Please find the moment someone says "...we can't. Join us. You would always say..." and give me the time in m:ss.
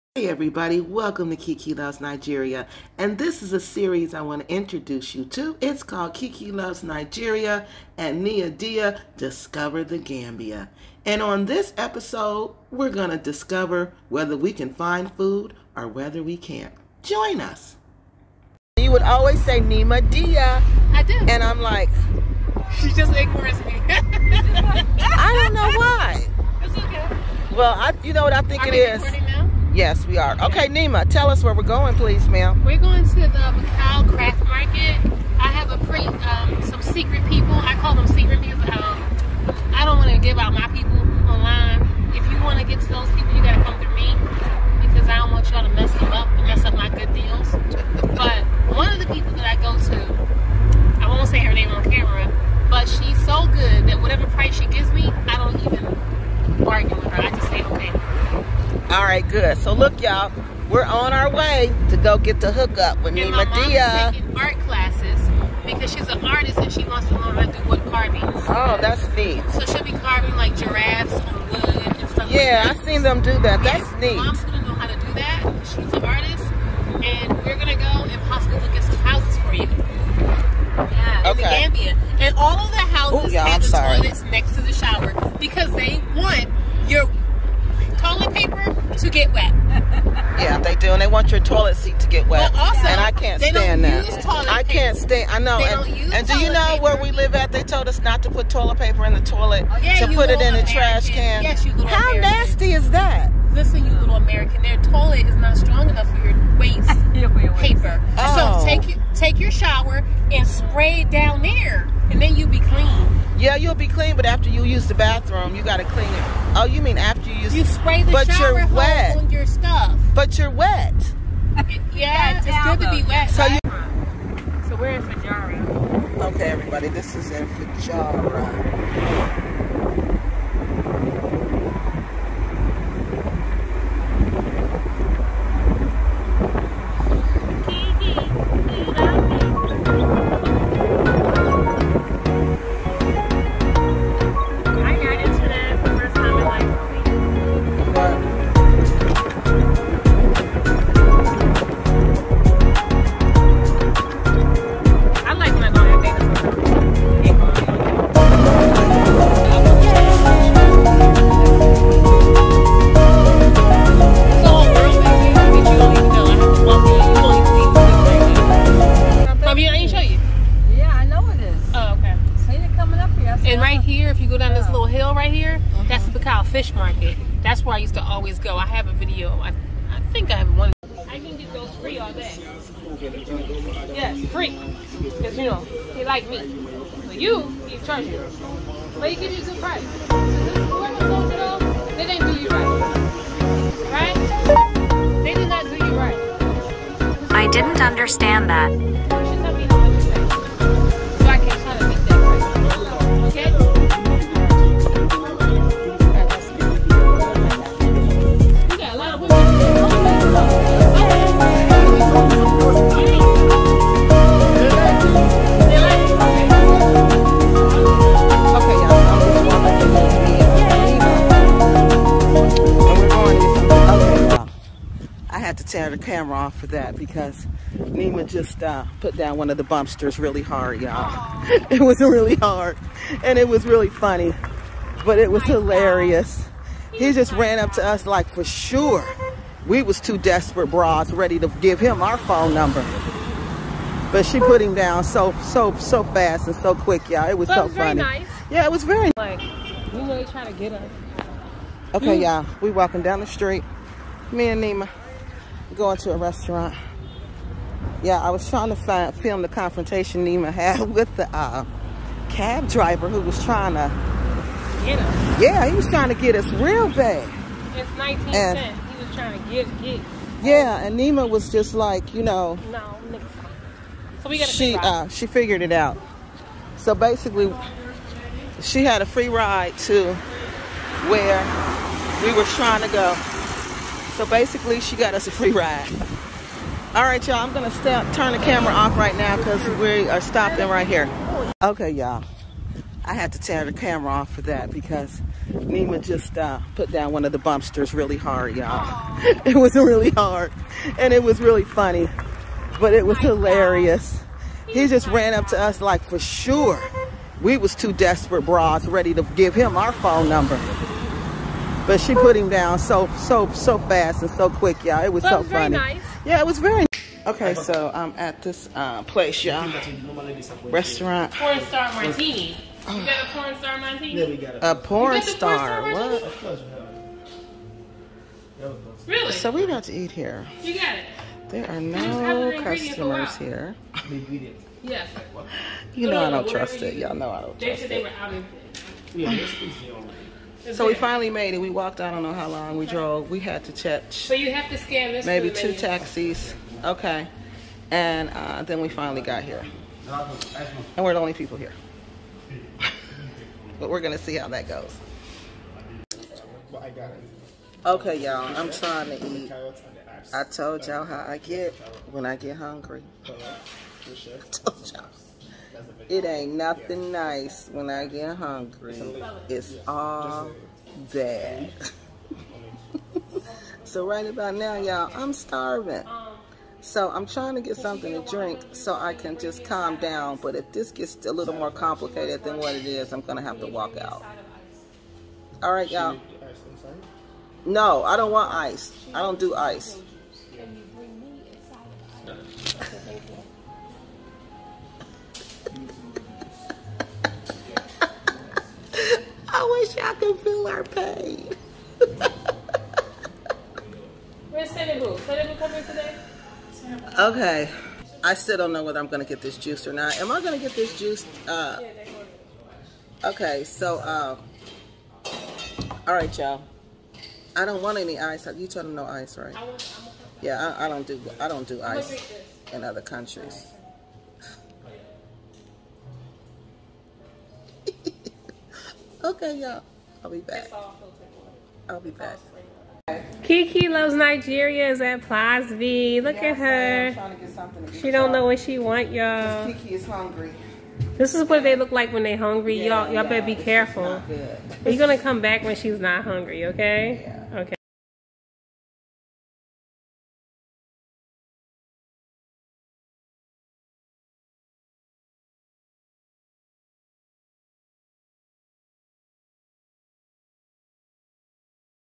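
0:16.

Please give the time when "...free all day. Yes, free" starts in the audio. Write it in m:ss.
3:01.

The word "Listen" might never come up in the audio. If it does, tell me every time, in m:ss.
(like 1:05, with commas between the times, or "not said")
1:43.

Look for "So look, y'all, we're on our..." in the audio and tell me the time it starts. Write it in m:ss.
0:59.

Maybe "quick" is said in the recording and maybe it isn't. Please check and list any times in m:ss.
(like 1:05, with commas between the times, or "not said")
4:06, 5:14.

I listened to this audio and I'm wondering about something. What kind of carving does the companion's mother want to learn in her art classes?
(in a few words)
Wood carvings.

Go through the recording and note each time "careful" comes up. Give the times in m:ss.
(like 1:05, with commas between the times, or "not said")
7:23.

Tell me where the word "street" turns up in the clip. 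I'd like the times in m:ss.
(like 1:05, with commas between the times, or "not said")
4:13.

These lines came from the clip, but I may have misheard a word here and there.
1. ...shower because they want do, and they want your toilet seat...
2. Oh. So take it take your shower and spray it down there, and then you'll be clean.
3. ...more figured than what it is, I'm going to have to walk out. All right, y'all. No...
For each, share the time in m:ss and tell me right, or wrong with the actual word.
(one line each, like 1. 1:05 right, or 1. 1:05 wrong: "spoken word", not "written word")
1. 1:24 right
2. 1:48 right
3. 6:21 wrong: "complicated", not "figured".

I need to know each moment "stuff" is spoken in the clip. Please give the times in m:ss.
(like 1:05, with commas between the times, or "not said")
1:12, 1:59.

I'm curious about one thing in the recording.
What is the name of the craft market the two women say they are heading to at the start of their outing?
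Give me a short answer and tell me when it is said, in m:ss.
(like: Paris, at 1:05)
Bakau Craft Market, at 0:33.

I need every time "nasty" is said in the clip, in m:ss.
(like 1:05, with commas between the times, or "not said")
1:42.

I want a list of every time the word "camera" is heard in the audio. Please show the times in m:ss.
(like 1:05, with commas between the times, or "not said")
3:46, 4:48, 4:53.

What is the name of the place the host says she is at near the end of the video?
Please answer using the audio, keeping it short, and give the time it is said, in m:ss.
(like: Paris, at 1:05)
Plaza V, at 7:15.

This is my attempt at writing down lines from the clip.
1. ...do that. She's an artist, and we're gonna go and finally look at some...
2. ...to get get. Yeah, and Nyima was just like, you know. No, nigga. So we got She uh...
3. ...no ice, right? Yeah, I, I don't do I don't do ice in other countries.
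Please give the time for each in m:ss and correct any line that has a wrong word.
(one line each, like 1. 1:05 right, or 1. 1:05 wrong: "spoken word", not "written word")
1. 1:15 wrong: "possibly", not "finally"
2. 4:29 right
3. 6:58 right.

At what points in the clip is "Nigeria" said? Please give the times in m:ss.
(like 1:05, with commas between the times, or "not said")
0:02, 0:06, 7:14.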